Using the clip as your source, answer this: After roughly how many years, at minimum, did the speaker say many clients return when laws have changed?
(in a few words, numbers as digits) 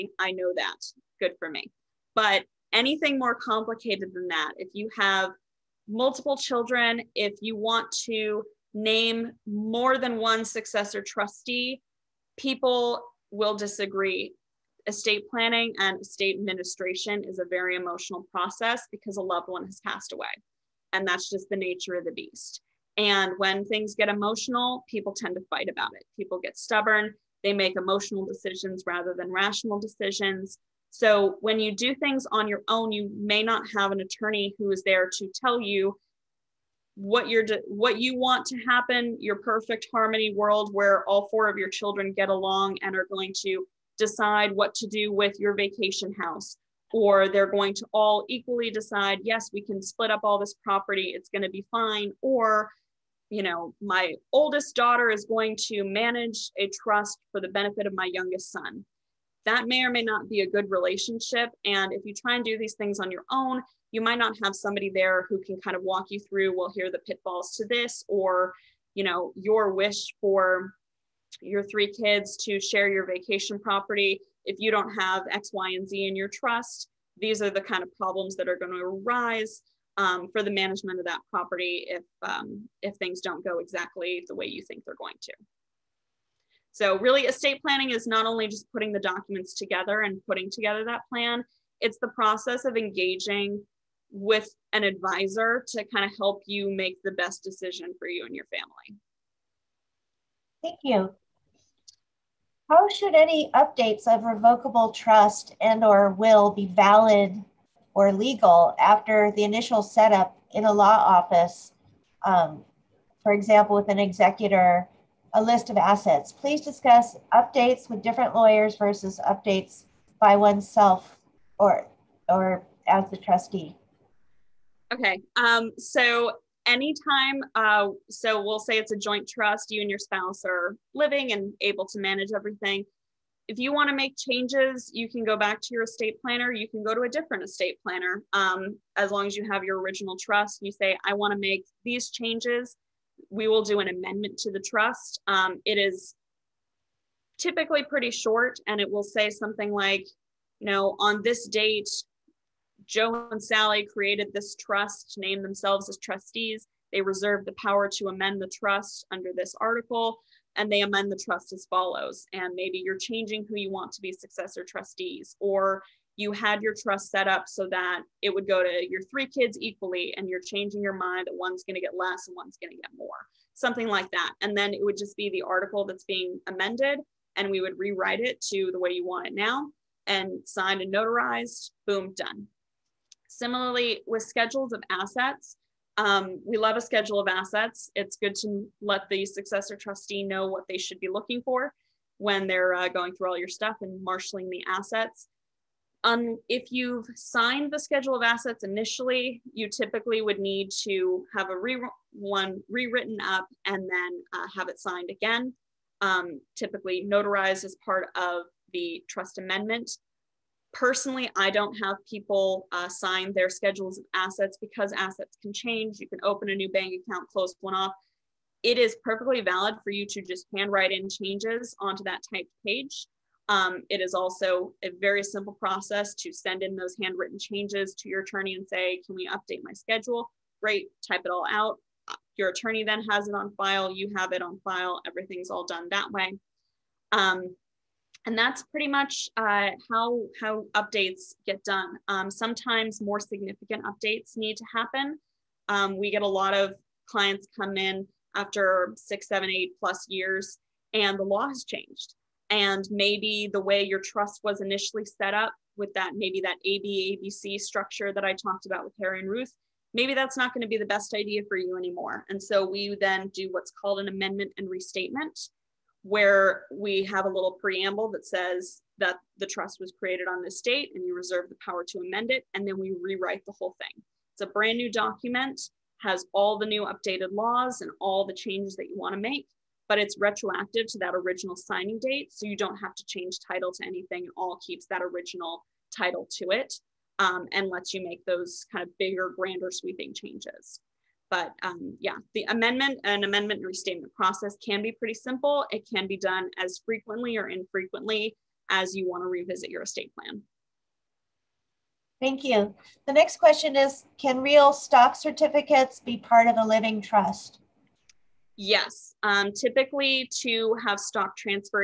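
6.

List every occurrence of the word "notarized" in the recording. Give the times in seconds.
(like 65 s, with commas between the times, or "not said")
180 s, 207 s.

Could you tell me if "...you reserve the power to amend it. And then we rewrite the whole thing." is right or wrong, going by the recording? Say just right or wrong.
right.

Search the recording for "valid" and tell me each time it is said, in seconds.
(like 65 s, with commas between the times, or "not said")
106 s, 219 s.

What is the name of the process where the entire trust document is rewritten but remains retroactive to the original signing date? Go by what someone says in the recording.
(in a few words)
amendment and restatement.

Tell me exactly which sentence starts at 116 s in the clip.
Please discuss updates with different lawyers versus updates by oneself or, or as the trustee.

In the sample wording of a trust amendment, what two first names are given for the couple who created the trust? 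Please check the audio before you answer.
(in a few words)
Joe and Sally.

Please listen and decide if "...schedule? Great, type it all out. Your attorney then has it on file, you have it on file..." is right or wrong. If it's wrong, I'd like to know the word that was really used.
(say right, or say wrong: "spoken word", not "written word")
right.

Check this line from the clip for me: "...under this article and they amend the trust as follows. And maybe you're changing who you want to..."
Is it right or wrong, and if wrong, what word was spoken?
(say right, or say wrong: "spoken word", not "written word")
right.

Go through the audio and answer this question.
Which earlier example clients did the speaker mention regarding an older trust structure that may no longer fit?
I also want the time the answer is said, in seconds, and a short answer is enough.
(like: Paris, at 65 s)
Harry and Ruth, at 258 s.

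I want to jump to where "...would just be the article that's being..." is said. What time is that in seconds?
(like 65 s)
174 s.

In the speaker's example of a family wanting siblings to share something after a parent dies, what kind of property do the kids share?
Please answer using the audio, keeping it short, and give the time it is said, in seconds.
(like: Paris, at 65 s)
vacation house, at 45 s.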